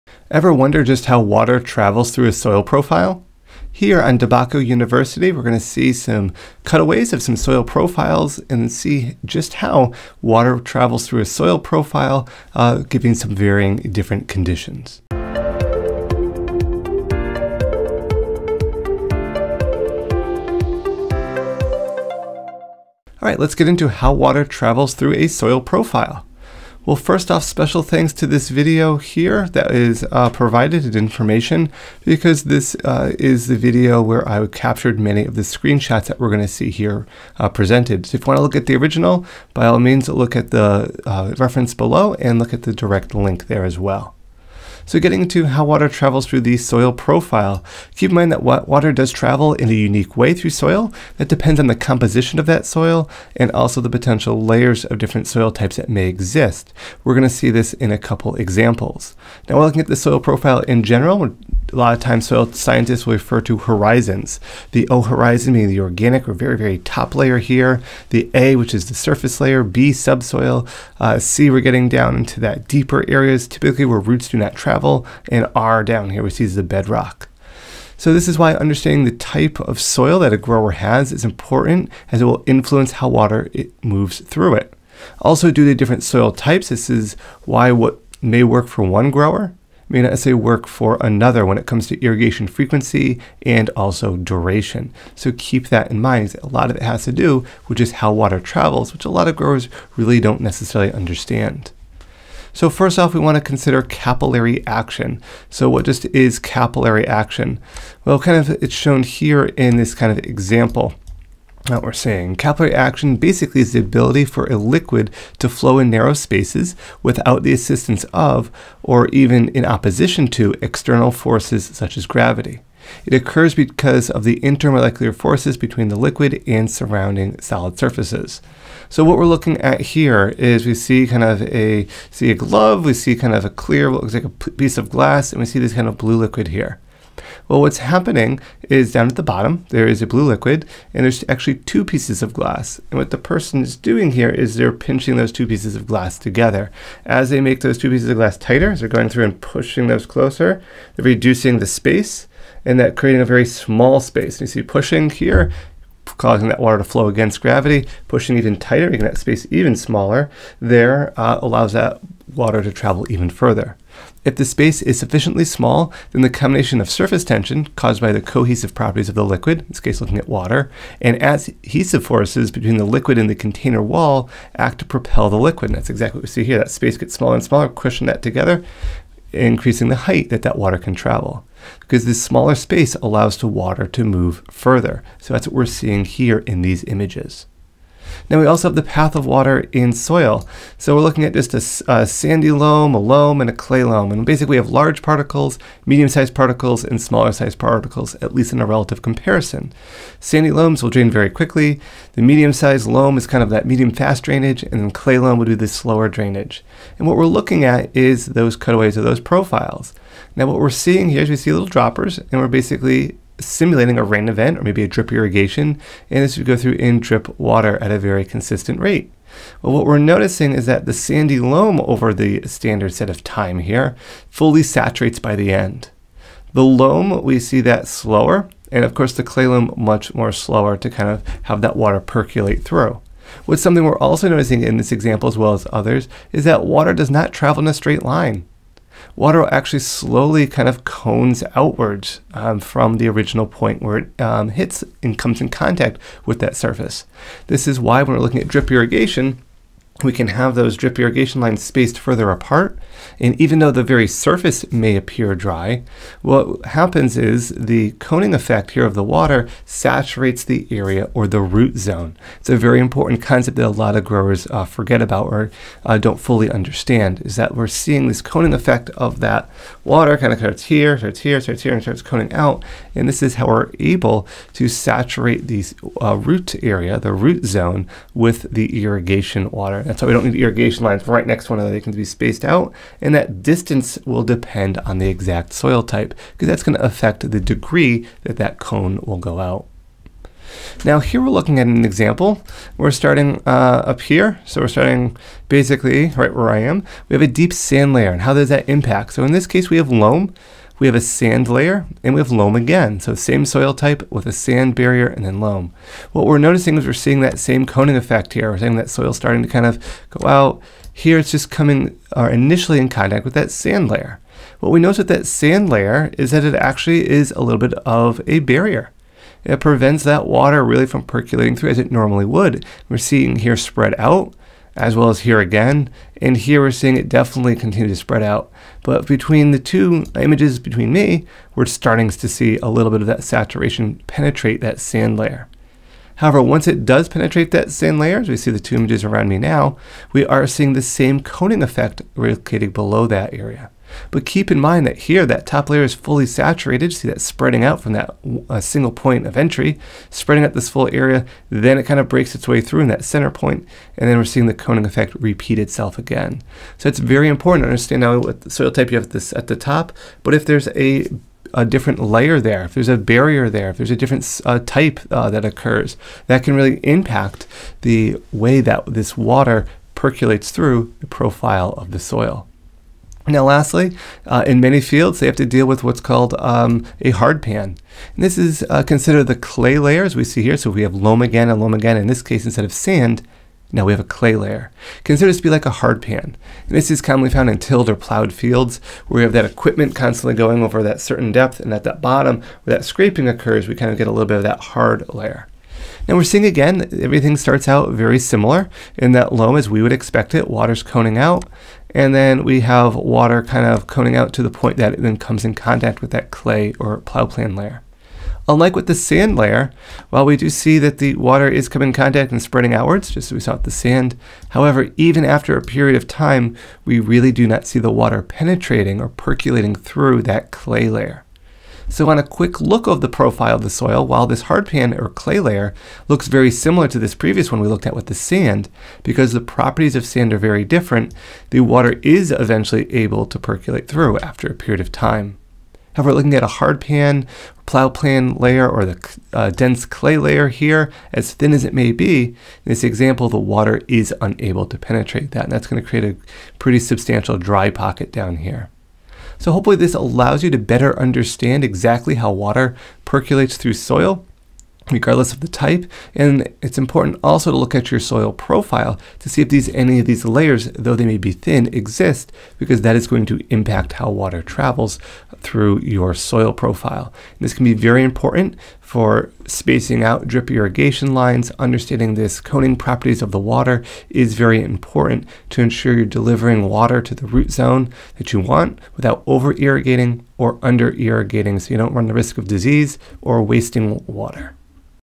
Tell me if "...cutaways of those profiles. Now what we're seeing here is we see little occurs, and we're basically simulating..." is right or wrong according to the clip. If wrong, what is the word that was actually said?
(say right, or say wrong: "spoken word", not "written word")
wrong: "droppers", not "occurs".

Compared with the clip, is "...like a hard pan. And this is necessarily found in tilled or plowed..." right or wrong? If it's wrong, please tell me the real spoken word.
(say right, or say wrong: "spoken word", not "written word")
wrong: "commonly", not "necessarily".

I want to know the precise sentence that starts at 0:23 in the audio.
All right, let's get into how water travels through a soil profile.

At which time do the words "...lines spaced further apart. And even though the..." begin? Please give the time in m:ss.
4:11.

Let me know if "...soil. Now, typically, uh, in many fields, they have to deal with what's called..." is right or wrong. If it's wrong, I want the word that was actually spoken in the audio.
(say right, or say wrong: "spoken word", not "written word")
wrong: "lastly", not "typically".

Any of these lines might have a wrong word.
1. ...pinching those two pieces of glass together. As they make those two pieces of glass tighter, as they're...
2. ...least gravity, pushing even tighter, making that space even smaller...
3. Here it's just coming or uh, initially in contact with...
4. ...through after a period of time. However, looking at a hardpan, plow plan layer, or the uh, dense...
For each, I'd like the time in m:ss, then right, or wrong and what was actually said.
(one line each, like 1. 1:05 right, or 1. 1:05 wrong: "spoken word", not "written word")
1. 2:24 right
2. 2:37 wrong: "against", not "least"
3. 5:10 right
4. 7:13 right.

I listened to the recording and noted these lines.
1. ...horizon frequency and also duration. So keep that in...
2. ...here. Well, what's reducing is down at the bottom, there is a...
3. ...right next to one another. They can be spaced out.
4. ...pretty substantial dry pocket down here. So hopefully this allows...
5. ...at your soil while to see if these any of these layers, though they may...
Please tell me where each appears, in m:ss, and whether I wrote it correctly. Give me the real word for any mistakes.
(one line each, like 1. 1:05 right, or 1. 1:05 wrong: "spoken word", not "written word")
1. 1:32 wrong: "irrigation", not "horizon"
2. 2:16 wrong: "happening", not "reducing"
3. 4:41 right
4. 7:26 right
5. 7:37 wrong: "profile", not "while".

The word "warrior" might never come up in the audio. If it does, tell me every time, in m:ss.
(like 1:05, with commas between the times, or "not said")
not said.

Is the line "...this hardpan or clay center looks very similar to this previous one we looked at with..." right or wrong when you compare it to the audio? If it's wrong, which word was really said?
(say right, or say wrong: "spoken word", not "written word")
wrong: "layer", not "center".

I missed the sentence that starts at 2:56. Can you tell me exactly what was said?
That space gets smaller and smaller, crushing that together, increasing the height that that water can travel.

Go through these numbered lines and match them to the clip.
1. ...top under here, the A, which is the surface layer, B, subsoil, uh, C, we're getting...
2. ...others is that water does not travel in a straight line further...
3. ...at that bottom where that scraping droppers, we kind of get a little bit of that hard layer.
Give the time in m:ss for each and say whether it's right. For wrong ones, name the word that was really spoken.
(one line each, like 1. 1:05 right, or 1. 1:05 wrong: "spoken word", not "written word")
1. 1:06 wrong: "layer", not "under"
2. 3:55 wrong: "water", not "further"
3. 6:31 wrong: "occurs", not "droppers".